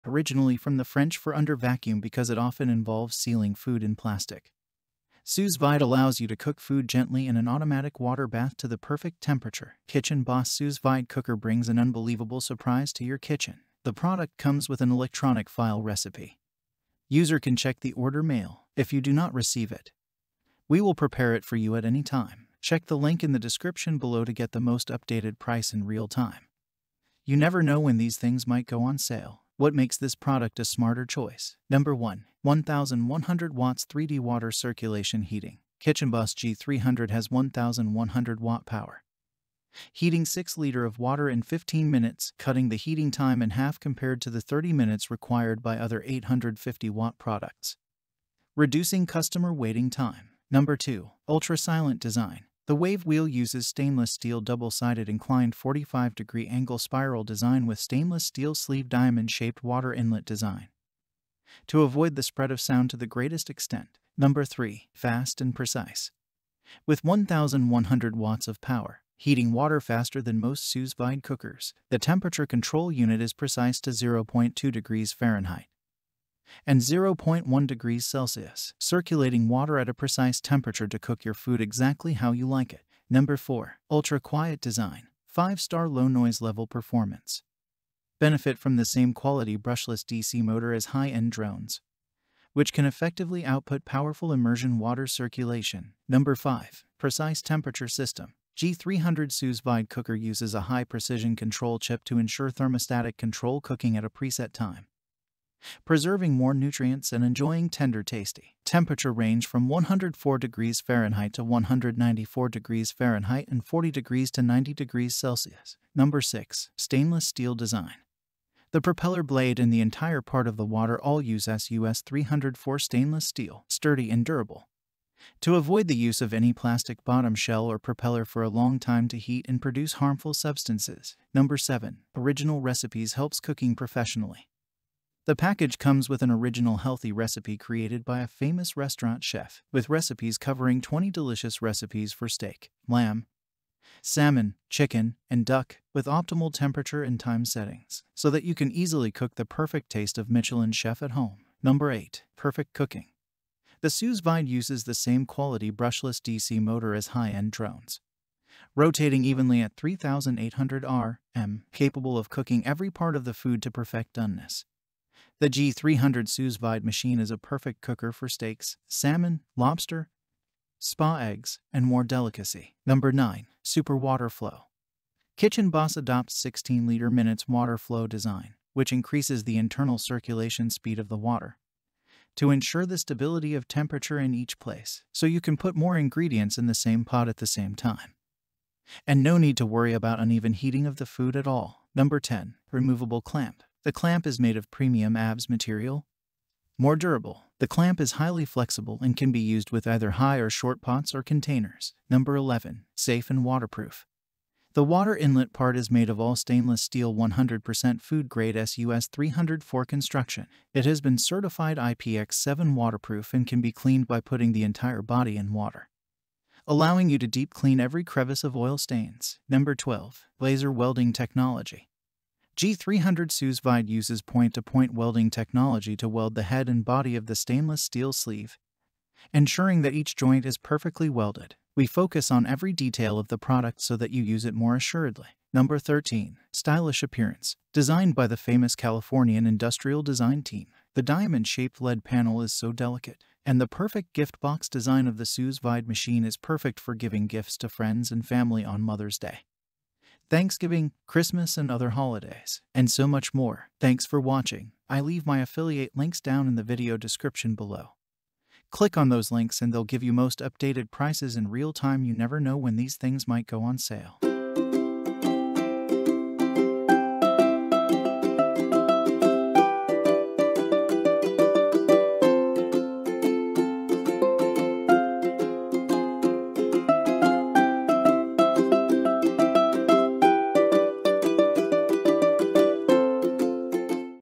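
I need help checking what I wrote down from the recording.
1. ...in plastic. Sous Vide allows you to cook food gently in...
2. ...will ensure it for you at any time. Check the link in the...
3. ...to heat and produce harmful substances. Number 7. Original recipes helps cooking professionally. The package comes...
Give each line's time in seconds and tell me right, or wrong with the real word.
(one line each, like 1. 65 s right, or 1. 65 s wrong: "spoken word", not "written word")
1. 3 s right
2. 20 s wrong: "prepare", not "ensure"
3. 129 s right.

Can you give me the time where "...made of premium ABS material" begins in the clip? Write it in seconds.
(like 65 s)
194 s.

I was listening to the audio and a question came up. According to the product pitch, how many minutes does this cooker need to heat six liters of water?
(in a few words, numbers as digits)
15 minutes.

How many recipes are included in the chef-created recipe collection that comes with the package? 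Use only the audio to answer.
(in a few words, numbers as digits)
20.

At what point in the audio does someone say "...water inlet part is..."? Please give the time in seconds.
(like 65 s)
204 s.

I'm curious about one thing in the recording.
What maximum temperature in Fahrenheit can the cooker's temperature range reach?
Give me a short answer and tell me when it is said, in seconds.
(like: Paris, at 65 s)
194 degrees Fahrenheit, at 111 s.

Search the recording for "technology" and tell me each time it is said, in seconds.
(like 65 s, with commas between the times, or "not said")
221 s, 225 s.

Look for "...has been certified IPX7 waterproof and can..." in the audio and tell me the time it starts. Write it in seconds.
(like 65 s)
210 s.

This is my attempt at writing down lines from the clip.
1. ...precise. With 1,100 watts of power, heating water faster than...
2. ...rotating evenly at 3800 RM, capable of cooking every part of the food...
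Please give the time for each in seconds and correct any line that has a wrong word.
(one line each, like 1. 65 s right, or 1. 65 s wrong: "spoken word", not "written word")
1. 65 s right
2. 158 s right.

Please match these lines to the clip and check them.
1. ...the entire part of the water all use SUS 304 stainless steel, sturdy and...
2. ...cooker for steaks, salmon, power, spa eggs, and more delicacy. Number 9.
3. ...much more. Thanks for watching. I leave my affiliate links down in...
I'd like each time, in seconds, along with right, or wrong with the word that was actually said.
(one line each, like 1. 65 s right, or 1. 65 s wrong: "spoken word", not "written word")
1. 119 s right
2. 167 s wrong: "lobster", not "power"
3. 253 s right.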